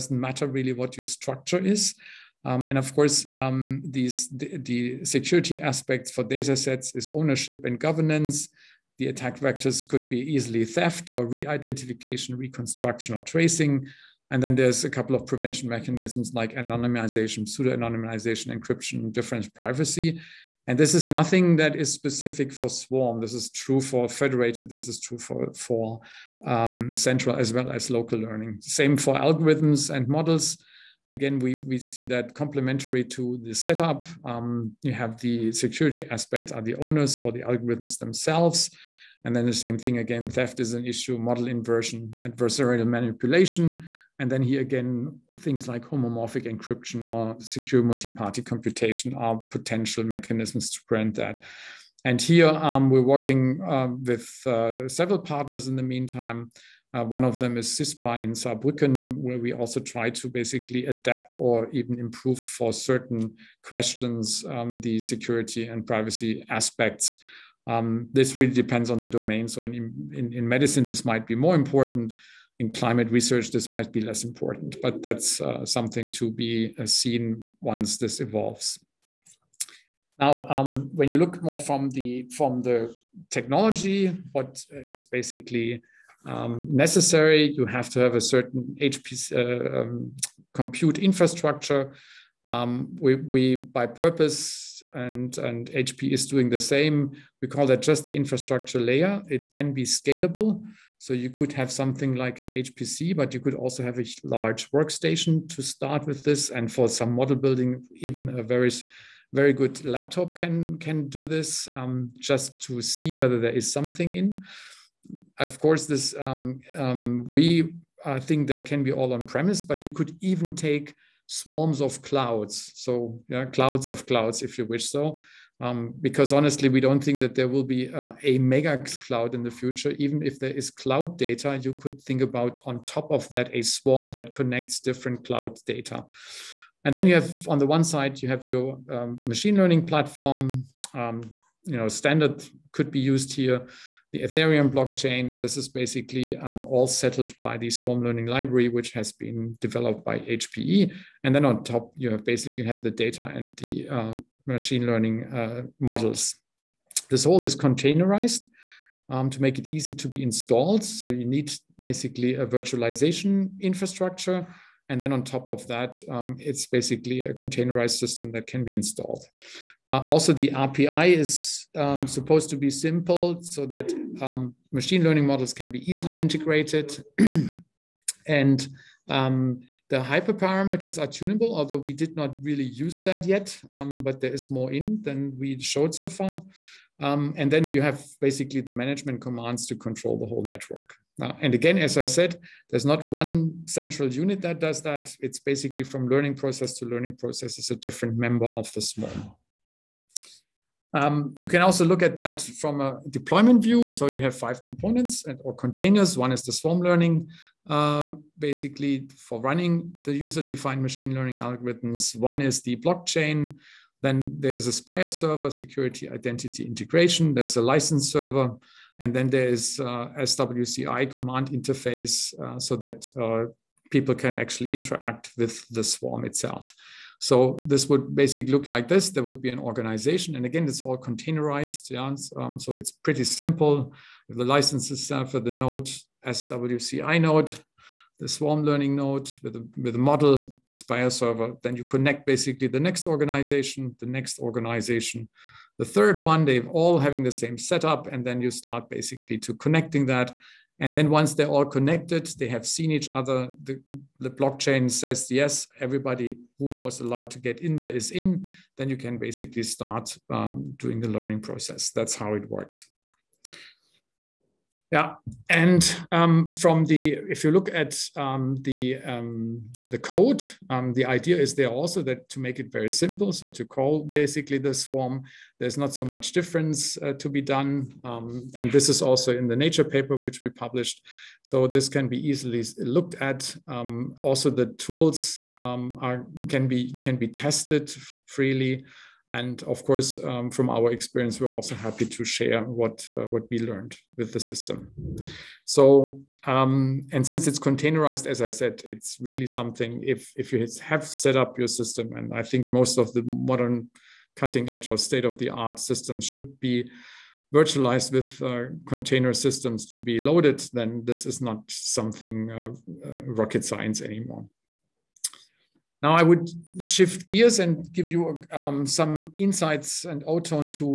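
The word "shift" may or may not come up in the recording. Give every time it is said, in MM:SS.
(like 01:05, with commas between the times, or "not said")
05:16.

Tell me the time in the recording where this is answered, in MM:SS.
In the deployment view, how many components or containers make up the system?
03:24.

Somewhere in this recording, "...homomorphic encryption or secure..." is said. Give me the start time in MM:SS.
00:45.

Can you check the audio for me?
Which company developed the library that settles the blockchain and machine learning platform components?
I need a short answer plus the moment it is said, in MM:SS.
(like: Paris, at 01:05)
HPE, at 02:30.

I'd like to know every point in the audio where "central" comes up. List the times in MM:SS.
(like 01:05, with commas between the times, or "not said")
00:26, 03:13.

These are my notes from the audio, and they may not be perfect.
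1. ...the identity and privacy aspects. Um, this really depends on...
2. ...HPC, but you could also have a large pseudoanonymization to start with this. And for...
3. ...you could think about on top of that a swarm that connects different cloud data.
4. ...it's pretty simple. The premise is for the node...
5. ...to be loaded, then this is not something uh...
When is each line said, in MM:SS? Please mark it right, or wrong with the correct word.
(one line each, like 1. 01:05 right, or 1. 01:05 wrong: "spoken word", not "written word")
1. 01:04 wrong: "security", not "identity"
2. 01:42 wrong: "workstation", not "pseudoanonymization"
3. 02:11 right
4. 03:52 wrong: "license", not "premise"
5. 05:09 right.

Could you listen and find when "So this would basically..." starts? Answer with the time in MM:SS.
03:47.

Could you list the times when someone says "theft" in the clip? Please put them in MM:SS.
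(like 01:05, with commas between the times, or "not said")
00:10, 00:40.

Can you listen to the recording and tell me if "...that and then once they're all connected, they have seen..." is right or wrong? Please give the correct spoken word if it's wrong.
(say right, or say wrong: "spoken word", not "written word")
right.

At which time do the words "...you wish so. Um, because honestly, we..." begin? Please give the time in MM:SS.
02:04.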